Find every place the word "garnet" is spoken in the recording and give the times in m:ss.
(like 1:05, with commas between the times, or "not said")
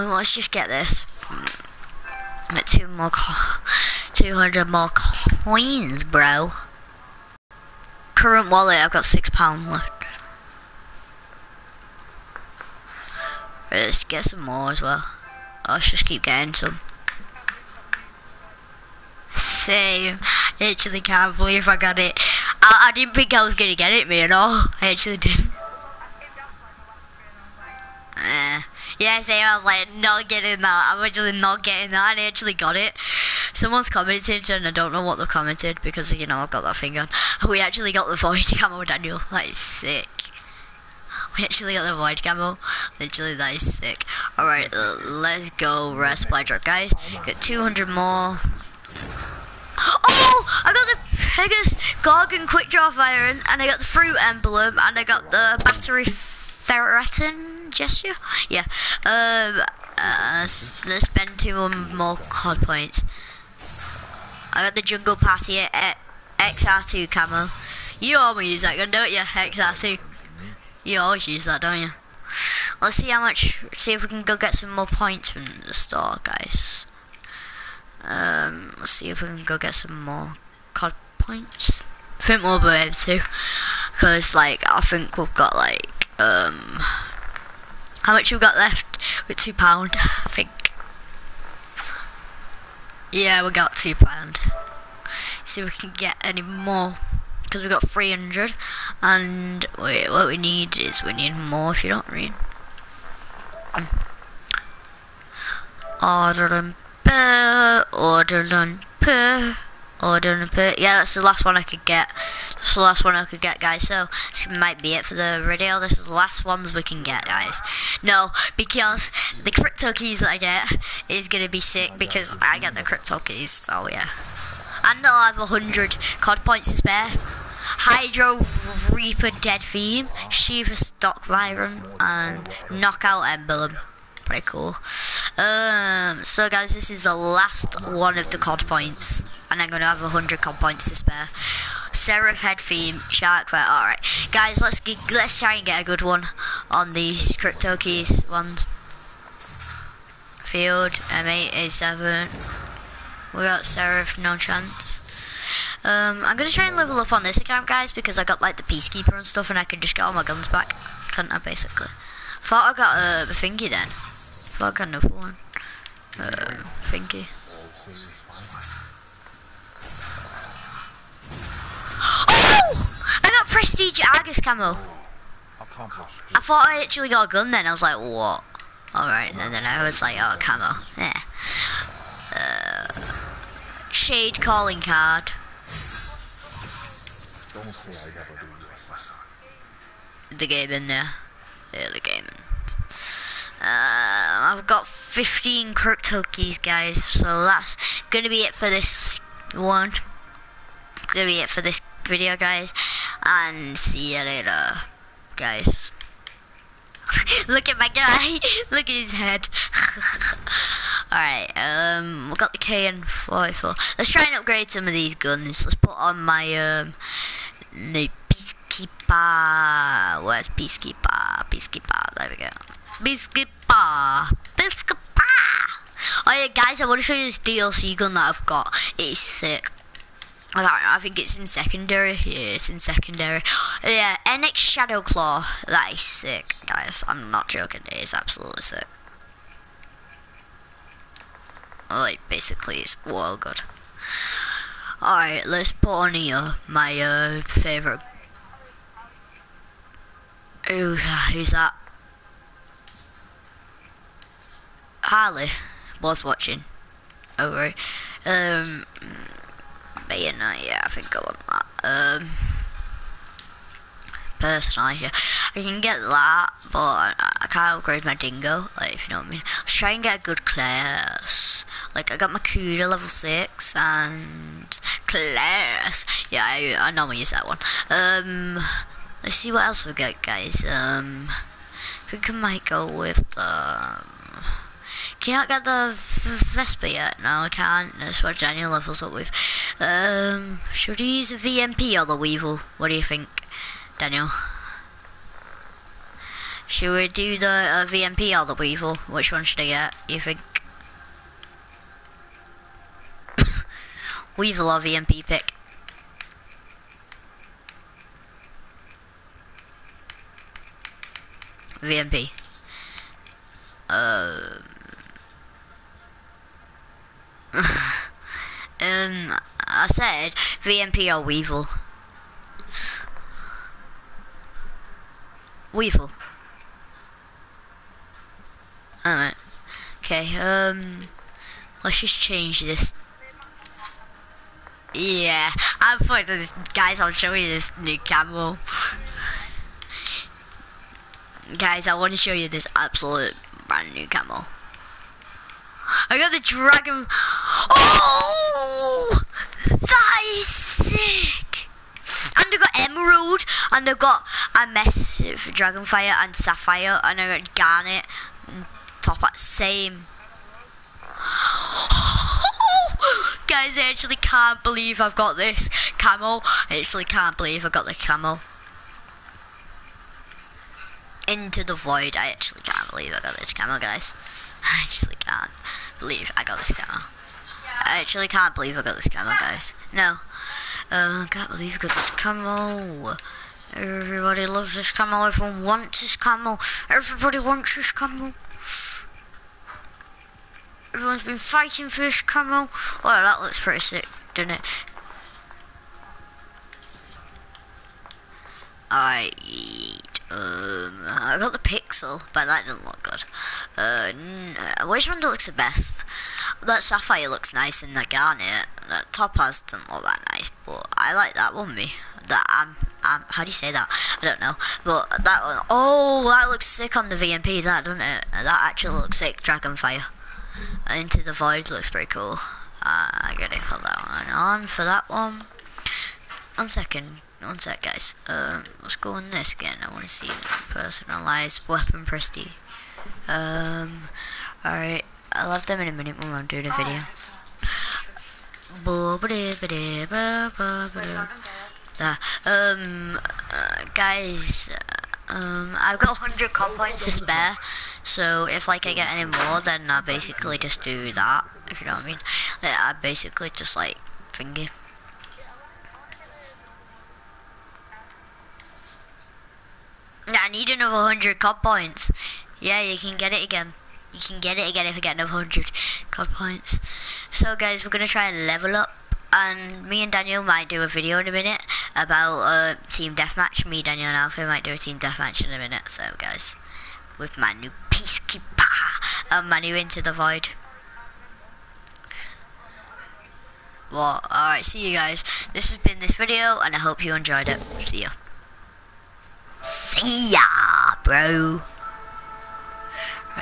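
5:57, 6:48.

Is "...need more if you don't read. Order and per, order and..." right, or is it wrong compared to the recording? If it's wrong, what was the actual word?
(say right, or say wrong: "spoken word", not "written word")
right.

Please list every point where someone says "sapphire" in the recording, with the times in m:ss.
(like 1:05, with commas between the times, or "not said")
5:56, 6:46.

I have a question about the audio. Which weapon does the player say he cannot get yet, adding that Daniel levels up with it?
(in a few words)
Vesper.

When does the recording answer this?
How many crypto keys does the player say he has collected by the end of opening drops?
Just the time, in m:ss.
3:14.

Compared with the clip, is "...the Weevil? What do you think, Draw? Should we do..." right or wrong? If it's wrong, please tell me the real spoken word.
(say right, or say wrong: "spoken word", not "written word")
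wrong: "Daniel", not "Draw".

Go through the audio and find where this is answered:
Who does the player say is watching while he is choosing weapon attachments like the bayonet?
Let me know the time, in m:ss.
4:15.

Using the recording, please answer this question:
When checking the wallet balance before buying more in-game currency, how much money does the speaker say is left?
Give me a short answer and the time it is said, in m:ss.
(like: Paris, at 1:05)
£6, at 0:09.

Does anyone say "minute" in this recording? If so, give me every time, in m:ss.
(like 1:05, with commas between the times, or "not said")
7:15, 7:51, 7:55.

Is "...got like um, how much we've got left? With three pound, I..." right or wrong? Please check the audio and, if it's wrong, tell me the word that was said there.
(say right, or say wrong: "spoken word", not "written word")
wrong: "two", not "three".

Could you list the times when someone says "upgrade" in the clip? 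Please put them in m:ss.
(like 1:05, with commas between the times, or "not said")
3:34, 4:27.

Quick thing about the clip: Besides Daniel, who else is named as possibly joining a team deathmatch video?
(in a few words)
Alpha.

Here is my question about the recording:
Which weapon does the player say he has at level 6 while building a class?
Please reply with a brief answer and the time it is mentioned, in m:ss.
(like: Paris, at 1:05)
Kuda, at 4:32.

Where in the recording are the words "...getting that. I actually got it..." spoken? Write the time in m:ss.
0:31.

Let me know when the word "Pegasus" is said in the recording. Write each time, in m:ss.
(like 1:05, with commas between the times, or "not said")
0:51.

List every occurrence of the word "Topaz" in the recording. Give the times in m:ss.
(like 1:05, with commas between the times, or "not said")
6:49.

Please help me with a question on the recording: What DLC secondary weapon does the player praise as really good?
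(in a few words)
NX Claw.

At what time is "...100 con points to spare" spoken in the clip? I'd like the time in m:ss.
2:20.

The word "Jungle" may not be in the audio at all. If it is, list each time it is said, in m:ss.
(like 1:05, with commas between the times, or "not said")
1:04.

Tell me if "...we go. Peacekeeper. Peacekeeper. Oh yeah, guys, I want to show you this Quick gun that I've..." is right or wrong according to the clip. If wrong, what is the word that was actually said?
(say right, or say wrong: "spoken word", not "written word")
wrong: "DLC", not "Quick".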